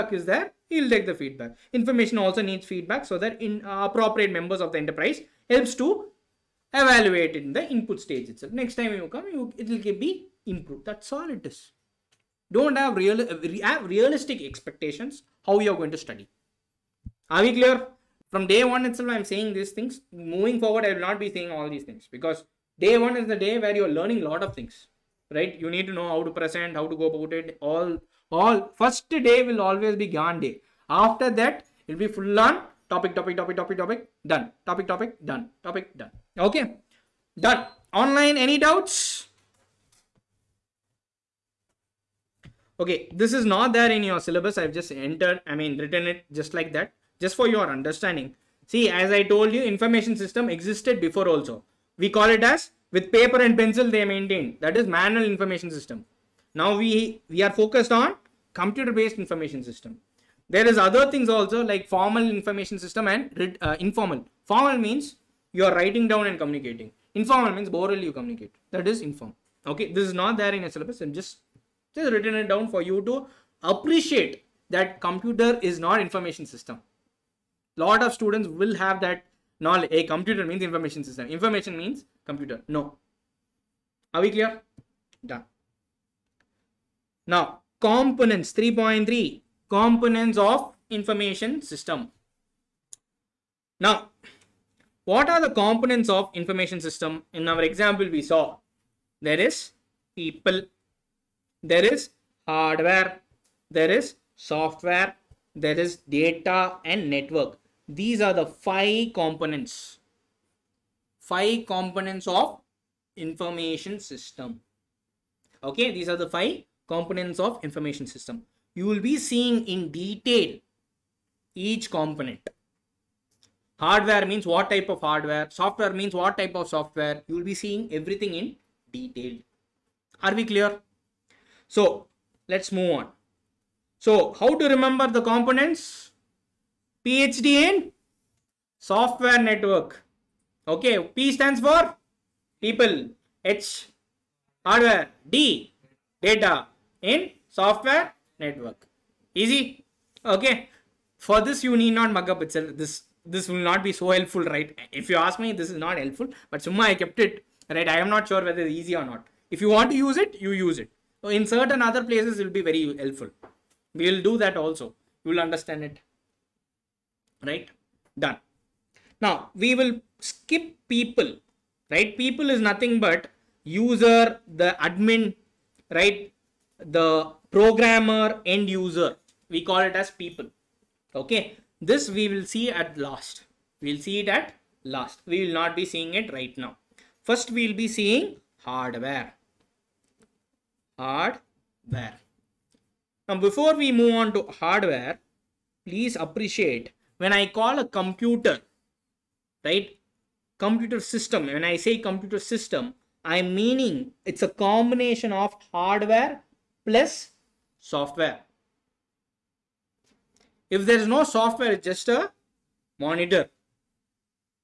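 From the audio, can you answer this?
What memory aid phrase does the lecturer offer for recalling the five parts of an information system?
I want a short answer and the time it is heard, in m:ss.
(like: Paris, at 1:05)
PhD in software network, at 2:17.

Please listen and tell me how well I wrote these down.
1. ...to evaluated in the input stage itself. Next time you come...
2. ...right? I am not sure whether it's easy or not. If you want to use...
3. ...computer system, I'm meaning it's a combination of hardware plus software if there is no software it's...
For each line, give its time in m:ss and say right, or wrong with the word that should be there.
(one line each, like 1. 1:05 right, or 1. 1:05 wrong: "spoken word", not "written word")
1. 0:05 right
2. 2:37 right
3. 3:21 right.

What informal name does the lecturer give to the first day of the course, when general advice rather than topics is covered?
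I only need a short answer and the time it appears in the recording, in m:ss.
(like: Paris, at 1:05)
Gyan day, at 0:30.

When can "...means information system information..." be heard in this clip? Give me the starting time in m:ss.
1:20.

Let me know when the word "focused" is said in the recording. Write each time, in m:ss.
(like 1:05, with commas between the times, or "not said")
0:57.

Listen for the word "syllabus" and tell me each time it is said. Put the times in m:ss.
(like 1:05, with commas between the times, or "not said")
0:44, 1:10.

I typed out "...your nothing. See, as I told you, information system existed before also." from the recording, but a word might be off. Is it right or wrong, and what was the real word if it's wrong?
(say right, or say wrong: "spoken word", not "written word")
wrong: "understanding", not "nothing".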